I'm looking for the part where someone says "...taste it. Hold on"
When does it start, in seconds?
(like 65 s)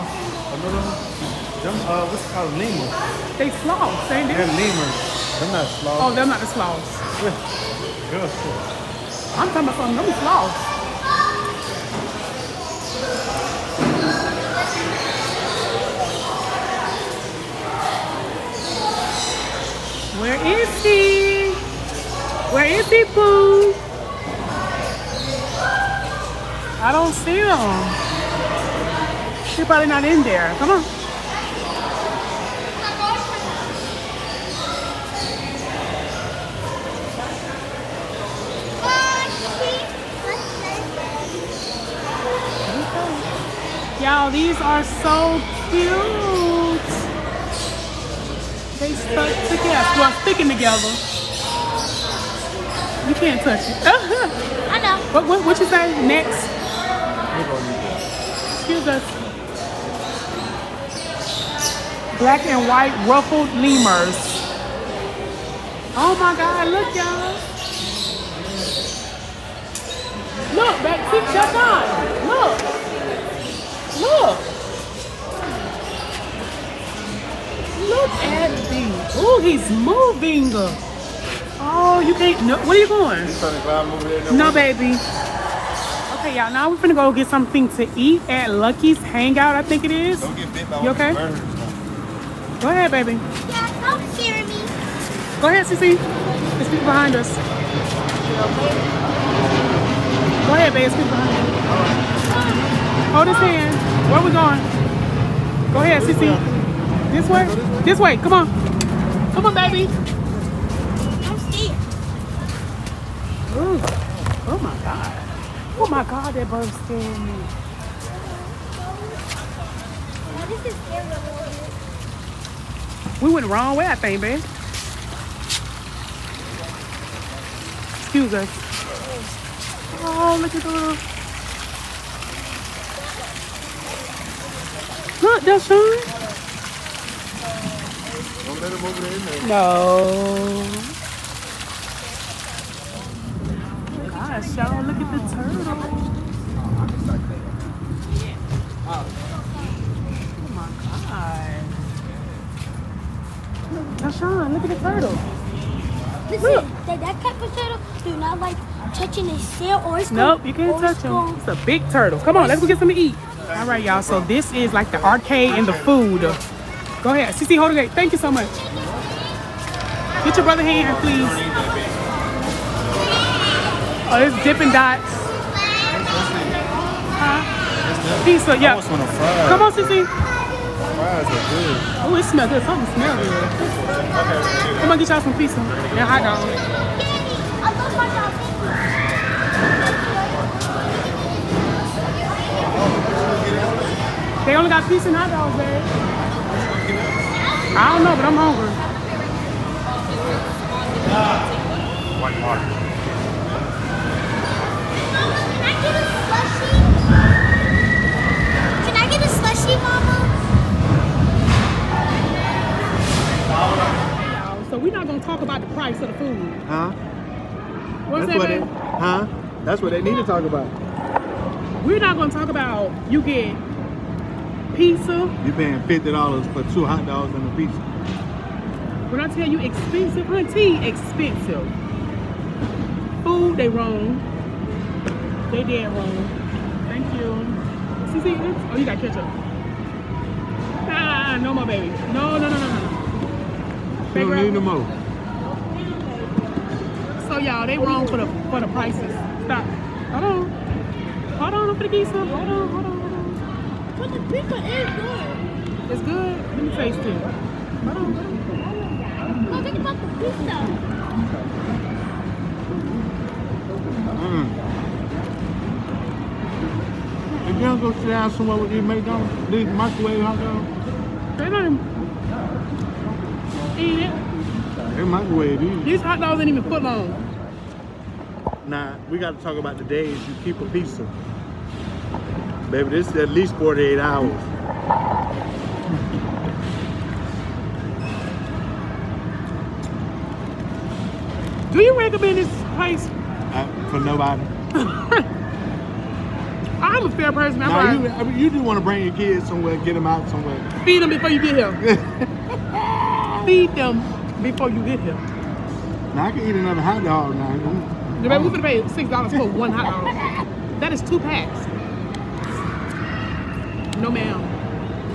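256 s.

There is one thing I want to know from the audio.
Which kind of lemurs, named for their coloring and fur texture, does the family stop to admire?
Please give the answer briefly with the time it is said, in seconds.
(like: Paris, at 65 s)
Black and white ruffled lemurs, at 62 s.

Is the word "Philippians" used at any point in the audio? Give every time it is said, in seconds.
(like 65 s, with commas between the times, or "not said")
not said.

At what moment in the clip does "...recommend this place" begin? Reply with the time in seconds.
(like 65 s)
291 s.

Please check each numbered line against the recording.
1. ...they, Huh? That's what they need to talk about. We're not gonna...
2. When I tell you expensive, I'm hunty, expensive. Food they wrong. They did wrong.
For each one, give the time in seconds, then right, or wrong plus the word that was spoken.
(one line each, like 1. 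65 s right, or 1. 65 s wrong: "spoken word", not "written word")
1. 218 s right
2. 229 s right.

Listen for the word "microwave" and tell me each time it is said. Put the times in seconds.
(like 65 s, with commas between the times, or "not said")
269 s, 275 s.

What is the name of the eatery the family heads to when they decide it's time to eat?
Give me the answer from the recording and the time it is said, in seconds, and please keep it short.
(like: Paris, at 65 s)
Lucky's Hangout, at 88 s.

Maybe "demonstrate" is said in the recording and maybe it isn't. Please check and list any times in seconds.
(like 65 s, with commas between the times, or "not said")
not said.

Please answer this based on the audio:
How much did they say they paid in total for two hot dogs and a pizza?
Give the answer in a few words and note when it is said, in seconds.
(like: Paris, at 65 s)
$50, at 225 s.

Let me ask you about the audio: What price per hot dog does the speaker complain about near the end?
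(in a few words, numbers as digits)
$6.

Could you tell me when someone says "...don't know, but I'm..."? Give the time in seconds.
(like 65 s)
197 s.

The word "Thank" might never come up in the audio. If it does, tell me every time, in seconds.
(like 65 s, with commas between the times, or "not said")
167 s, 236 s.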